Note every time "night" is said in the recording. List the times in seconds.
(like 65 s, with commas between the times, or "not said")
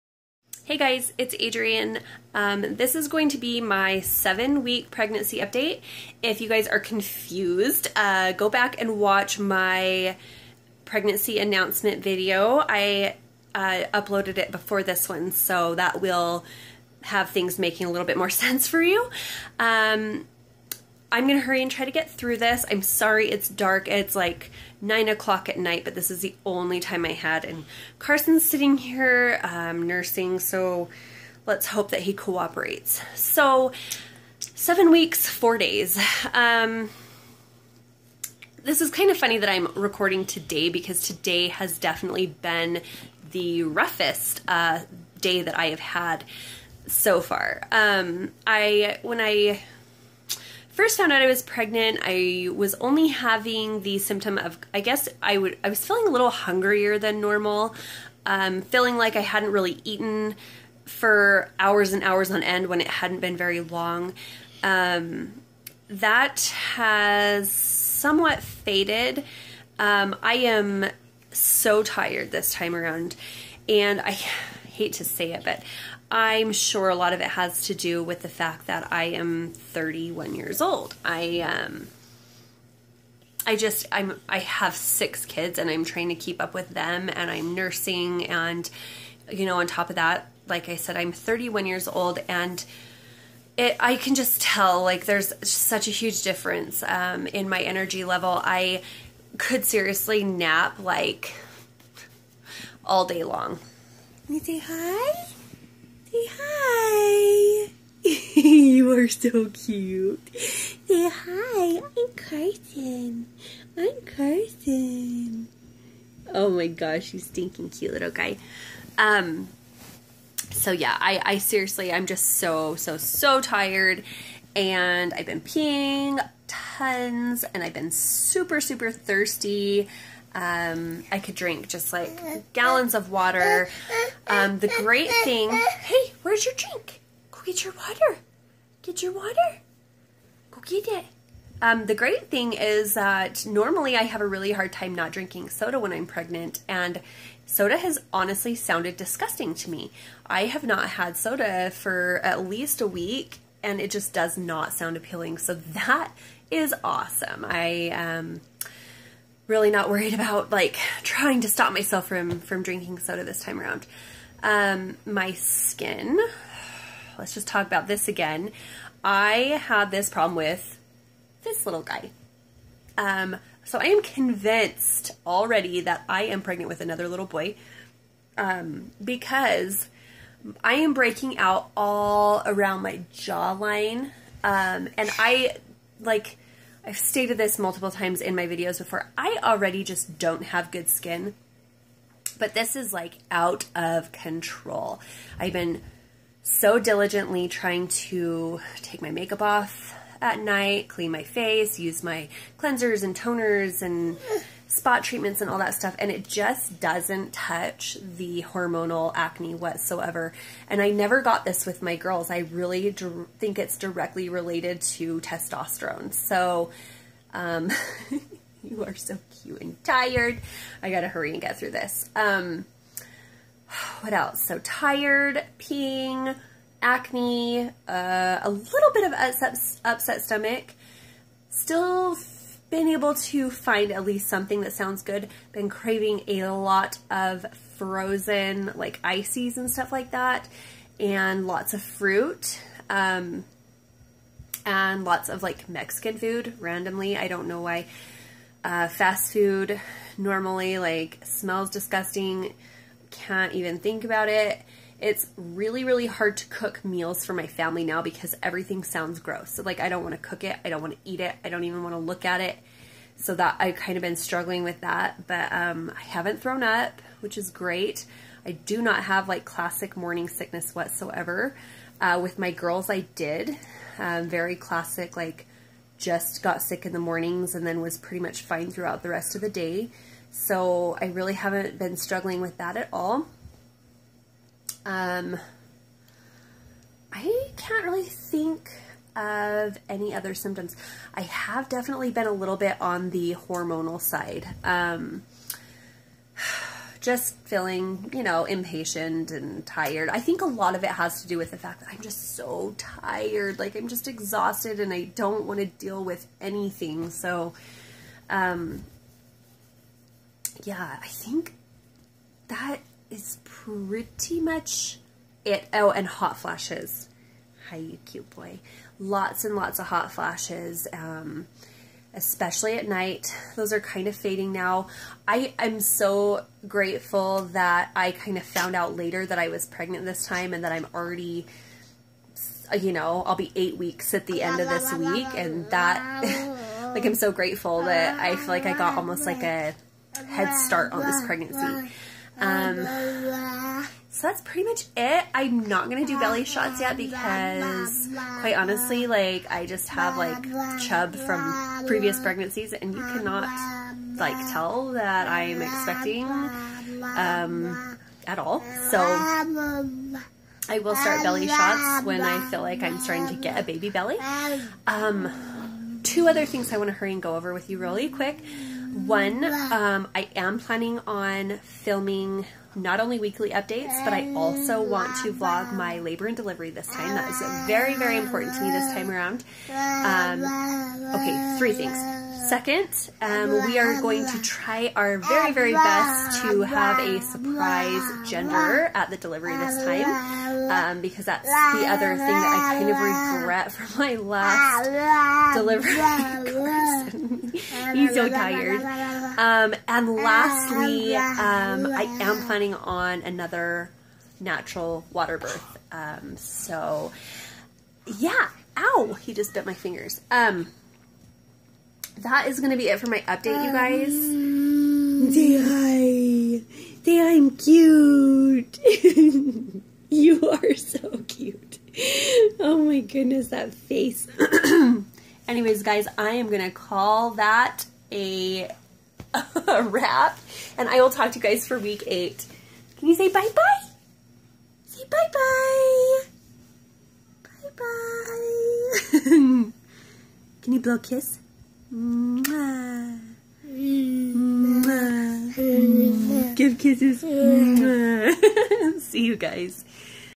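25 s, 200 s, 322 s.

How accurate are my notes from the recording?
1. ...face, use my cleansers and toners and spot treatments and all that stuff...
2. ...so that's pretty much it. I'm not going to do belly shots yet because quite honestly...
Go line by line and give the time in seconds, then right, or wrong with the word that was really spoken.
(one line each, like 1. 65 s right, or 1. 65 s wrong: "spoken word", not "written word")
1. 201 s right
2. 344 s right.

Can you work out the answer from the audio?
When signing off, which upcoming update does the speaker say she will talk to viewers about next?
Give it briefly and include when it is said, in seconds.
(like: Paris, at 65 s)
Week 8, at 431 s.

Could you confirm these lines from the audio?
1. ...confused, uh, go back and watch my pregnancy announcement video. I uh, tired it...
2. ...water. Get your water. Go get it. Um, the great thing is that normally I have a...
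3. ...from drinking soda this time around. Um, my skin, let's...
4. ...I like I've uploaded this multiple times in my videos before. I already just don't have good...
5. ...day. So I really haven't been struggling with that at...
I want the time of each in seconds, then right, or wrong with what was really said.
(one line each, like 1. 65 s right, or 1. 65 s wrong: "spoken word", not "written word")
1. 6 s wrong: "uploaded", not "tired"
2. 137 s right
3. 162 s right
4. 185 s wrong: "stated", not "uploaded"
5. 279 s right.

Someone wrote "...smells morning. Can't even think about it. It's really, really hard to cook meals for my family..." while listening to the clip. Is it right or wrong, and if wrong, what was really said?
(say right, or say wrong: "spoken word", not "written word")
wrong: "disgusting", not "morning".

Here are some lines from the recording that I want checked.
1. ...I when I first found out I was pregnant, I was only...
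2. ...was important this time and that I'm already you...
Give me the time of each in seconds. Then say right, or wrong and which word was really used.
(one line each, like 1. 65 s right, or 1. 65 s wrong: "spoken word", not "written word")
1. 48 s right
2. 329 s wrong: "pregnant", not "important".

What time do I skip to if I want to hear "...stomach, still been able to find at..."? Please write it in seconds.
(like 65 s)
230 s.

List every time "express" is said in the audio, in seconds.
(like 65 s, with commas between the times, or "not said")
not said.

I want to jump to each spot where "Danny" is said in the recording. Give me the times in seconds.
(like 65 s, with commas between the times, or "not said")
not said.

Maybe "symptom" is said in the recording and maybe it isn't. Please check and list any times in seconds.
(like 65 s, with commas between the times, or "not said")
53 s, 290 s.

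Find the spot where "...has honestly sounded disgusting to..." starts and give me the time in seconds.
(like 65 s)
147 s.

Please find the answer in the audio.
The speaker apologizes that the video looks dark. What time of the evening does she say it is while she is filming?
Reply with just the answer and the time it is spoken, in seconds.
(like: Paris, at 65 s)
9 o'clock, at 24 s.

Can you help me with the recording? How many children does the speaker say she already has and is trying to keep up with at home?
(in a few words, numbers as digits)
6.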